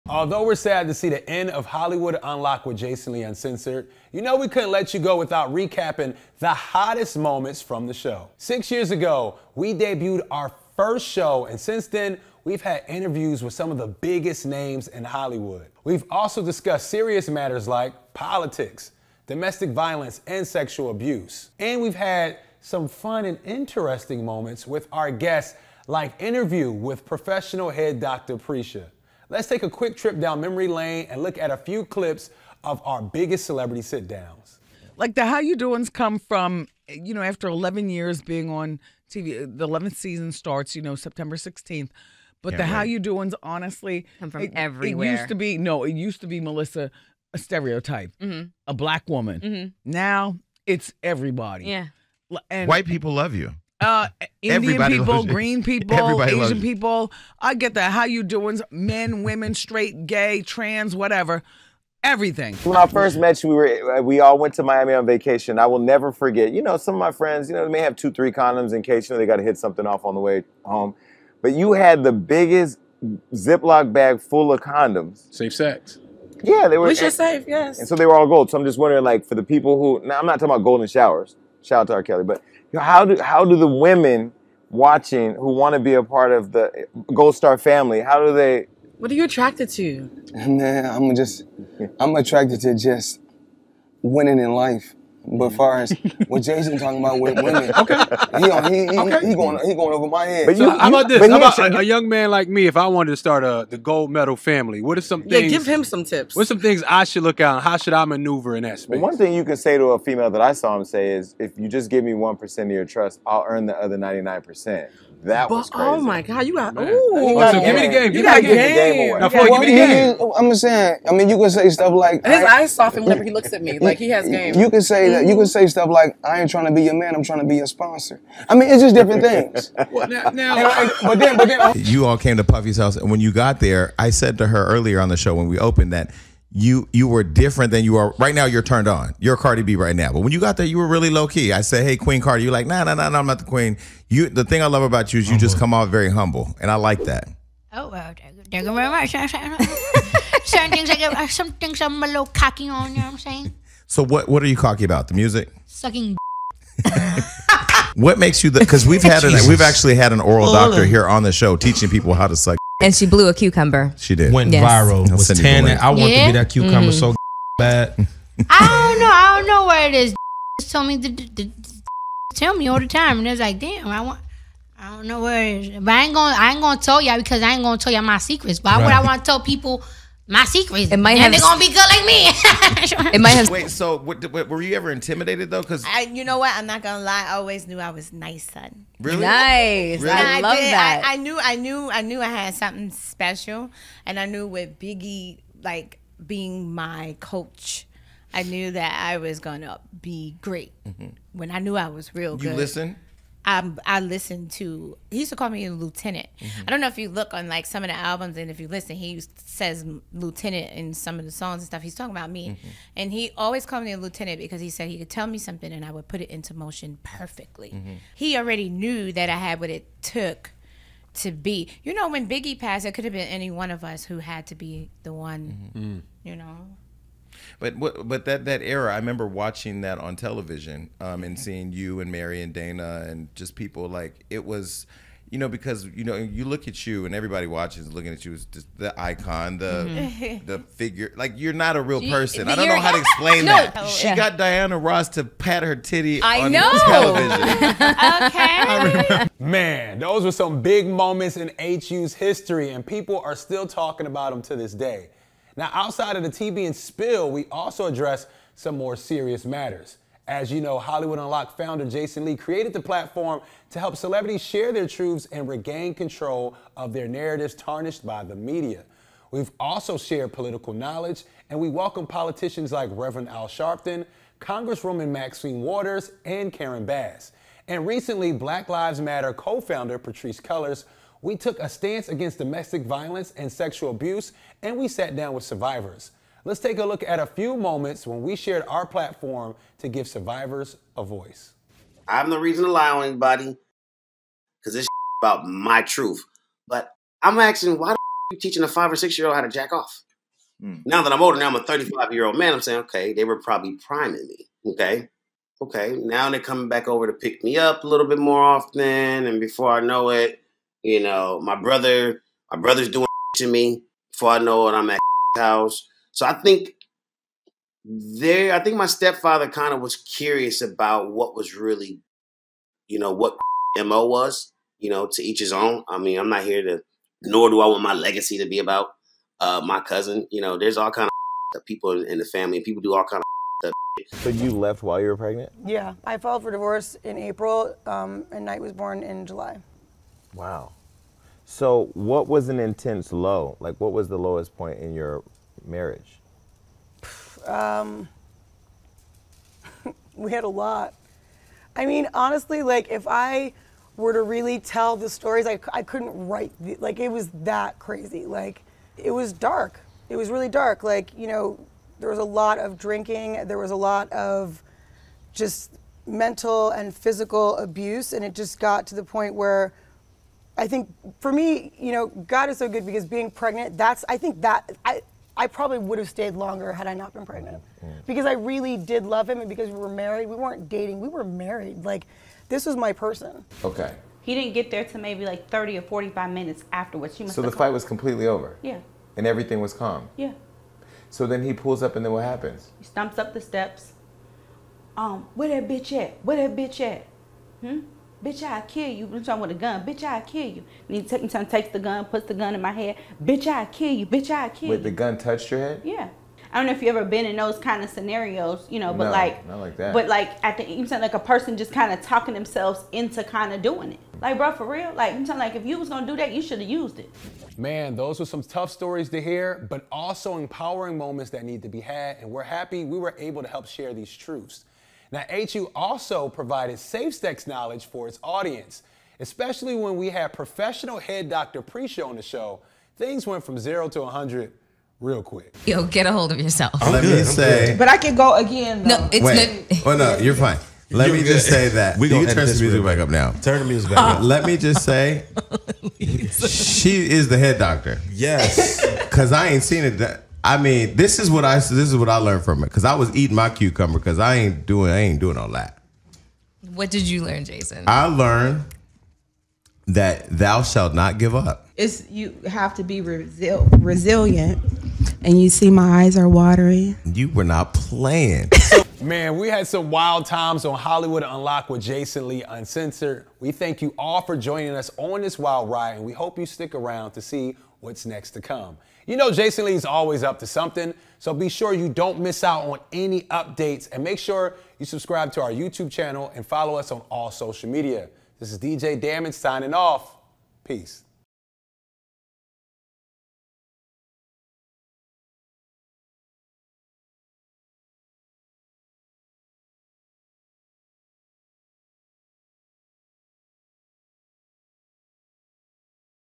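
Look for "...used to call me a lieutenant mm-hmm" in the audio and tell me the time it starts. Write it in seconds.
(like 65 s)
205 s.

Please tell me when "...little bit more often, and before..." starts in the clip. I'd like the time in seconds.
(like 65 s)
307 s.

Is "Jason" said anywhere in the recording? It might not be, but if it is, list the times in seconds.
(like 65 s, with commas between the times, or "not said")
2 s, 96 s, 261 s, 457 s, 471 s, 479 s.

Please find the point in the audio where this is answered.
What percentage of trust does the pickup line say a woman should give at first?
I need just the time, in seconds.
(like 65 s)
112 s.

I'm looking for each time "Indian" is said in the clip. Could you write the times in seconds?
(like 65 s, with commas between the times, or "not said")
54 s.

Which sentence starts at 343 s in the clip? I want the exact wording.
Like, what was the lowest point in your marriage?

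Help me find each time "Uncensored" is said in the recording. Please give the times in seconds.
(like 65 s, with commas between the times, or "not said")
3 s, 472 s.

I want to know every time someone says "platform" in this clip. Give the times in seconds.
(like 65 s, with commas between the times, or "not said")
262 s, 288 s.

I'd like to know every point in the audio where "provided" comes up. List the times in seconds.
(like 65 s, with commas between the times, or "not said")
426 s.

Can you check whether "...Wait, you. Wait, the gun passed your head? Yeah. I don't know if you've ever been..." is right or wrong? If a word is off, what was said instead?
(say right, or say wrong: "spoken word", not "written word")
wrong: "touched", not "passed".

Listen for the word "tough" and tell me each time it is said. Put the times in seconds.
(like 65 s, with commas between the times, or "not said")
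418 s.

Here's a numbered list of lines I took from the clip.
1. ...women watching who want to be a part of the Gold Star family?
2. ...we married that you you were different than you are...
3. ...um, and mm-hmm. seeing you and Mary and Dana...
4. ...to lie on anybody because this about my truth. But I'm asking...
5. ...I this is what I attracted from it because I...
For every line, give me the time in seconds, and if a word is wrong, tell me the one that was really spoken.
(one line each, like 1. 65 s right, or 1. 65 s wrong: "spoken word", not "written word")
1. 83 s right
2. 135 s wrong: "opened", not "married"
3. 230 s right
4. 292 s right
5. 451 s wrong: "learned", not "attracted".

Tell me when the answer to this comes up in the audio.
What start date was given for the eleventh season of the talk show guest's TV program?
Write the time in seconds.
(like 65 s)
40 s.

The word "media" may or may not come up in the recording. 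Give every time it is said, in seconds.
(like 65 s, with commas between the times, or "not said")
268 s, 487 s.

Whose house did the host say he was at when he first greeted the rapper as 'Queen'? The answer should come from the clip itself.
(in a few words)
Puffy's.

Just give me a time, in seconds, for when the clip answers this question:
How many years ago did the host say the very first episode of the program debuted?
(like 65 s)
8 s.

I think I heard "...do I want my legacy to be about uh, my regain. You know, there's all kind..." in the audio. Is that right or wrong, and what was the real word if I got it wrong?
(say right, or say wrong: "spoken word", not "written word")
wrong: "cousin", not "regain".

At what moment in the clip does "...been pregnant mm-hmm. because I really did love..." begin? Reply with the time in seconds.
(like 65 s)
377 s.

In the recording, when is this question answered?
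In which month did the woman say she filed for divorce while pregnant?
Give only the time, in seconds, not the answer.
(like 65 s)
337 s.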